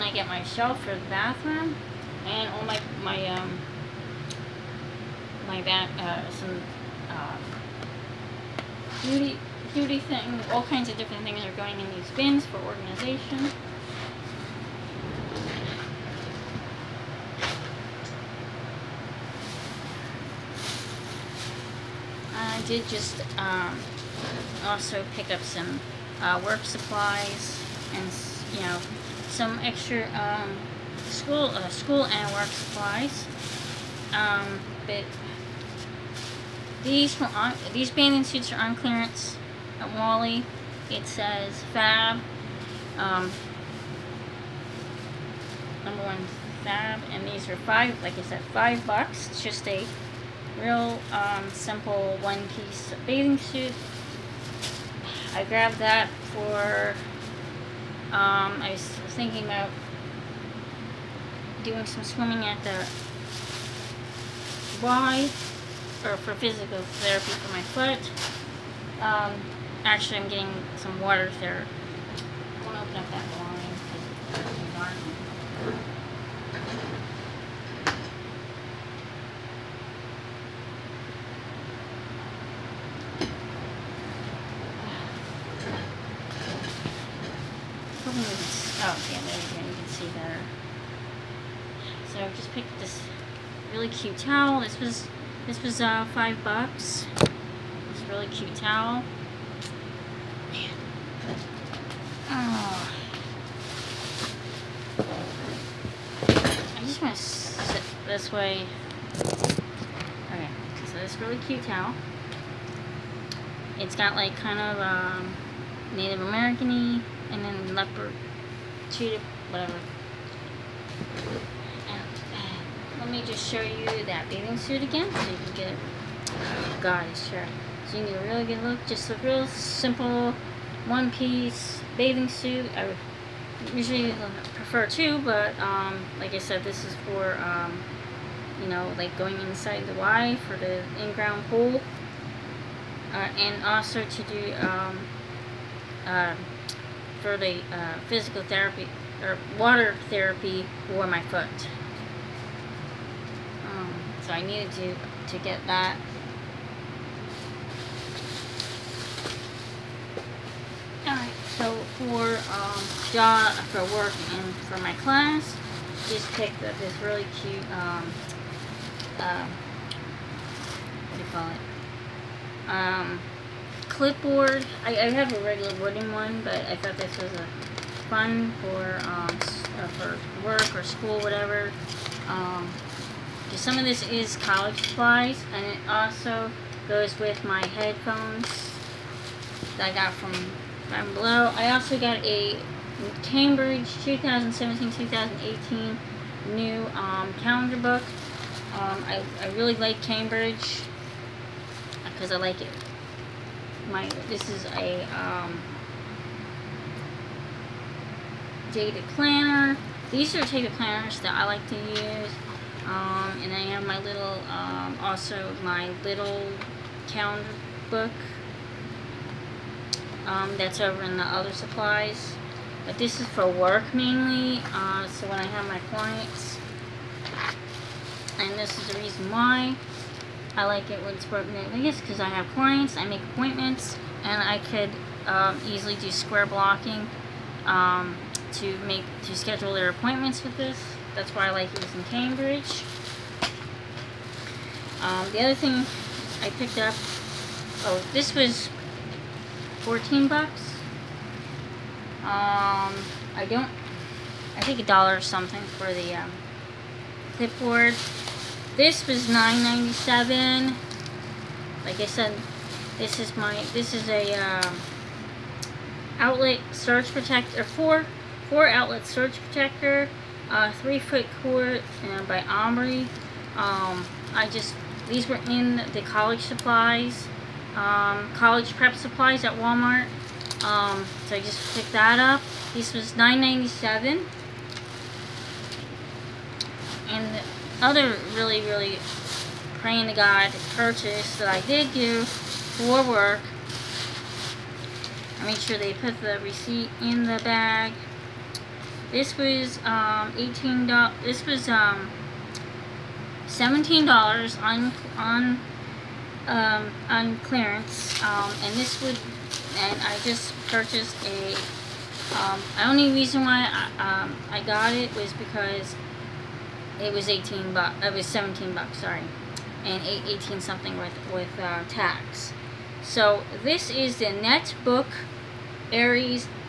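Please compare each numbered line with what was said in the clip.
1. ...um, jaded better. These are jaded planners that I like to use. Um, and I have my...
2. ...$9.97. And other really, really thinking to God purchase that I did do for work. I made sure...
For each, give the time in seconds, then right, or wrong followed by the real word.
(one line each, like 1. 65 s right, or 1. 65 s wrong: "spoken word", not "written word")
1. 205 s wrong: "planner", not "better"
2. 283 s wrong: "praying", not "thinking".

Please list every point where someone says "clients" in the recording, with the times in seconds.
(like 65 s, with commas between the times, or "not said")
225 s, 232 s.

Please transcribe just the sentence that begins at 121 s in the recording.
And uh, let me just show you that bathing suit again so you can get it.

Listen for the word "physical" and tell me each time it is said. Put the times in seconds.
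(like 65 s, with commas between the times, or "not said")
66 s, 148 s.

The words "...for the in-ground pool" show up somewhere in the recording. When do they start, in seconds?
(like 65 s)
140 s.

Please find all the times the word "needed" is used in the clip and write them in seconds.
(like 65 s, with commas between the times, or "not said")
154 s.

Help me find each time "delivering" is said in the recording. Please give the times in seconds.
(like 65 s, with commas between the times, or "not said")
not said.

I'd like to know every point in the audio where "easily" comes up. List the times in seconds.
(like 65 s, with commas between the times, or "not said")
235 s.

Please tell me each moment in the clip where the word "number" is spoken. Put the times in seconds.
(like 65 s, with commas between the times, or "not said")
45 s.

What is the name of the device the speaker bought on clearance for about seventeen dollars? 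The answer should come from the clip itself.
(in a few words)
NextBook Ares.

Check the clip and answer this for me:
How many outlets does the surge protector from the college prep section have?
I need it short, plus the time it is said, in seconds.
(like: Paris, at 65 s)
4, at 268 s.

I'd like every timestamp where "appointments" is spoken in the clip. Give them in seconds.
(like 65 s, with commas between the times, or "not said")
233 s, 239 s.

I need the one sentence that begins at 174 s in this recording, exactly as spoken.
I, I, have a regular wooden one, but I thought this was a fun for um, uh, for work or school, whatever.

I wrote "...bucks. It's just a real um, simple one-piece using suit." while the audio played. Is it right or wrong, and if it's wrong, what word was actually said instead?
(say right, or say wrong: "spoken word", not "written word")
wrong: "bathing", not "using".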